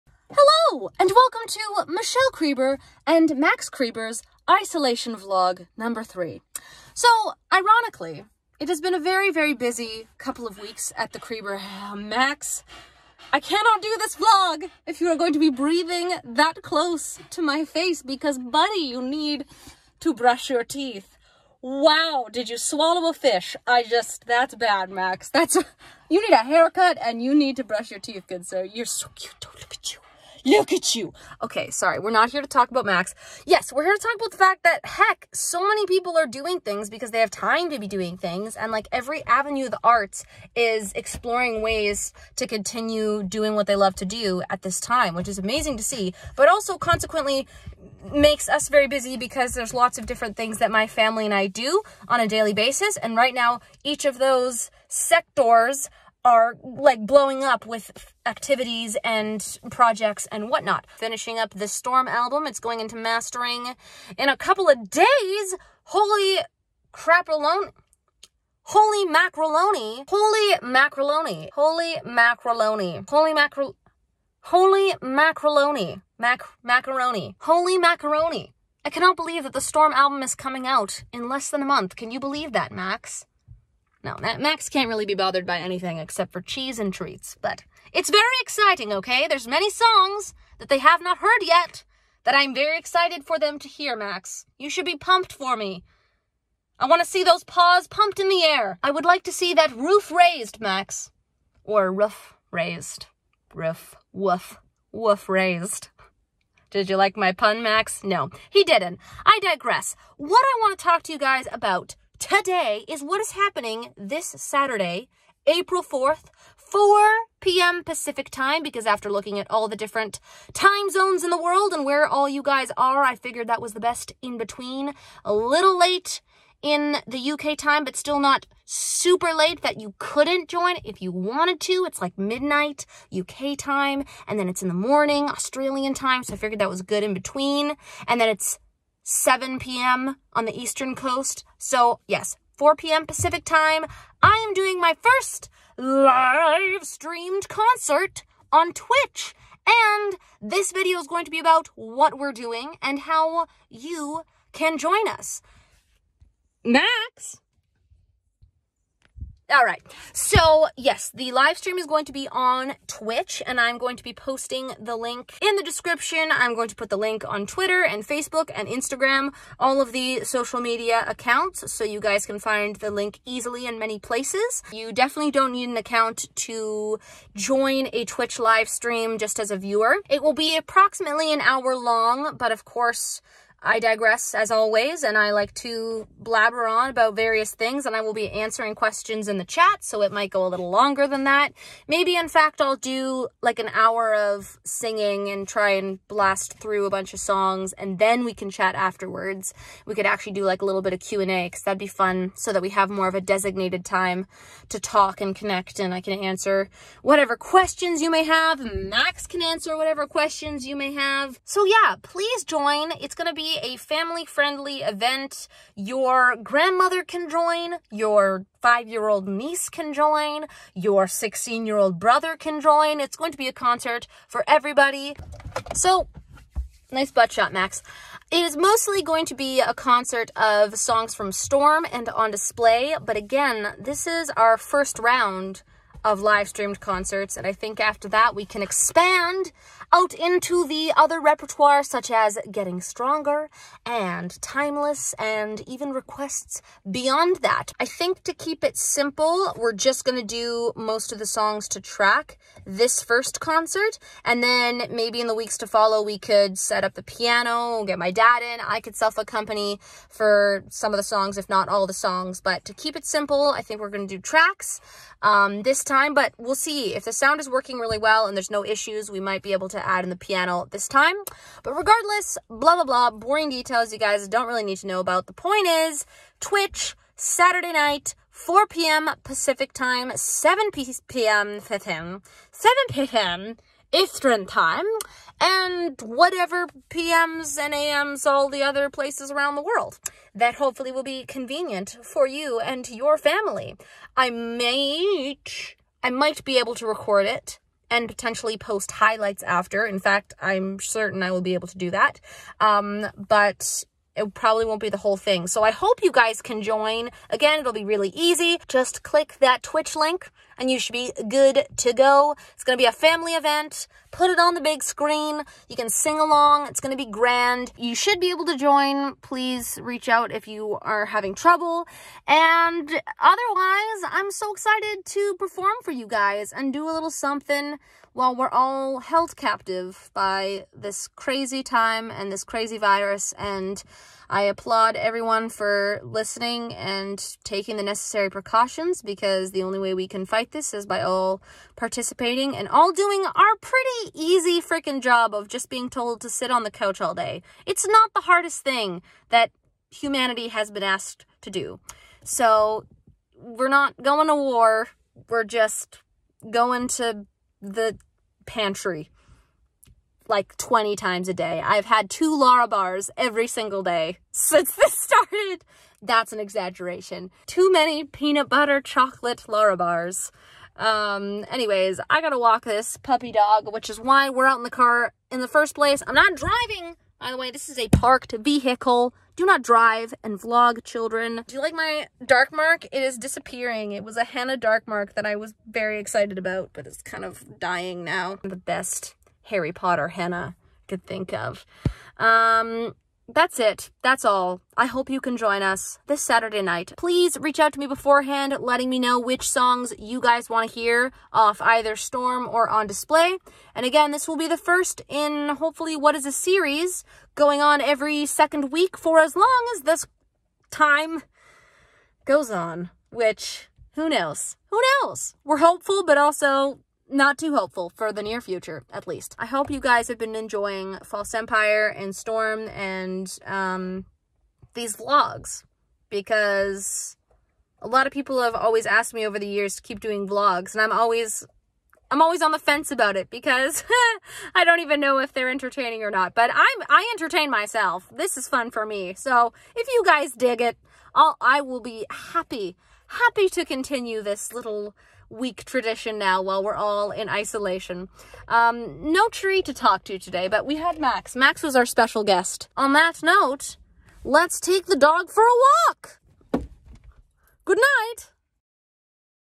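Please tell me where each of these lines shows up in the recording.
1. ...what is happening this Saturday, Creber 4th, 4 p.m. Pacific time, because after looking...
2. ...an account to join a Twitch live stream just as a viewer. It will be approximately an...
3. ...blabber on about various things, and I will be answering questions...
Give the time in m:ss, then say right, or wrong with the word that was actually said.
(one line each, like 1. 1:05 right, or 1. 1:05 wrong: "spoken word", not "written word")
1. 1:53 wrong: "April", not "Creber"
2. 2:55 right
3. 3:06 right.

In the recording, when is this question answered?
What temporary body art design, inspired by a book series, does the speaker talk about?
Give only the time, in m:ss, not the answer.
6:24.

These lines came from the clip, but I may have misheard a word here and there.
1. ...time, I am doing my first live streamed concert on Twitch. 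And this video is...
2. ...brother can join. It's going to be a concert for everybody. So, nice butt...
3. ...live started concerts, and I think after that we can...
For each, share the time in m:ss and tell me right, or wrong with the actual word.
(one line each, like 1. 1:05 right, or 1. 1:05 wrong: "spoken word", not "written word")
1. 2:23 right
2. 3:41 right
3. 3:56 wrong: "streamed", not "started".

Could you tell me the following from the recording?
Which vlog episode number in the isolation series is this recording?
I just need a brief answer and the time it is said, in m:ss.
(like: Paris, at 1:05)
3, at 0:04.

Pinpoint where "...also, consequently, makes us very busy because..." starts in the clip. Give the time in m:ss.
0:46.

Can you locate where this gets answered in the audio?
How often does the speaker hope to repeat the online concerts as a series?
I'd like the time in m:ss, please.
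6:47.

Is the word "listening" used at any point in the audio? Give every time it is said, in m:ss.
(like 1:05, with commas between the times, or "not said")
5:36.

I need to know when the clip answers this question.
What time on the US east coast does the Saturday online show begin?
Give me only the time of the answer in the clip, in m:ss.
2:18.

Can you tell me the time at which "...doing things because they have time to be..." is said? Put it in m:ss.
0:36.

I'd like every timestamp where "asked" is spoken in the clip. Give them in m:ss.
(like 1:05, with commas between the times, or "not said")
5:50, 7:08.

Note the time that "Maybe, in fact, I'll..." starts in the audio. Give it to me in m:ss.
3:11.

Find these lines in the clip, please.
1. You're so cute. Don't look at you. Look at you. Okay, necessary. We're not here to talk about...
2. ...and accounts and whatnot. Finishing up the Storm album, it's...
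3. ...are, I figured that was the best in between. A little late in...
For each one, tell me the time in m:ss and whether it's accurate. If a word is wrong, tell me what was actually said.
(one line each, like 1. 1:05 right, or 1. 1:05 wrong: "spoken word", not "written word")
1. 0:28 wrong: "sorry", not "necessary"
2. 0:59 wrong: "projects", not "accounts"
3. 2:02 right.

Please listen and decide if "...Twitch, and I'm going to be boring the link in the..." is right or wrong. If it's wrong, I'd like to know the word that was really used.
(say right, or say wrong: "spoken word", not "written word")
wrong: "posting", not "boring".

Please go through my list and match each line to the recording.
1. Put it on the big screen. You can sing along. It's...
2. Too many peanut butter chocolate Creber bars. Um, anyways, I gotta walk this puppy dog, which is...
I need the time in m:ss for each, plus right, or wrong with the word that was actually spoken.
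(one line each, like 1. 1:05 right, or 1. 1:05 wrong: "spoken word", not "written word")
1. 5:14 right
2. 6:07 wrong: "Lara", not "Creber".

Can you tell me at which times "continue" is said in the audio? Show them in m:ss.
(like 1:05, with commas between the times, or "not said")
0:42, 7:23.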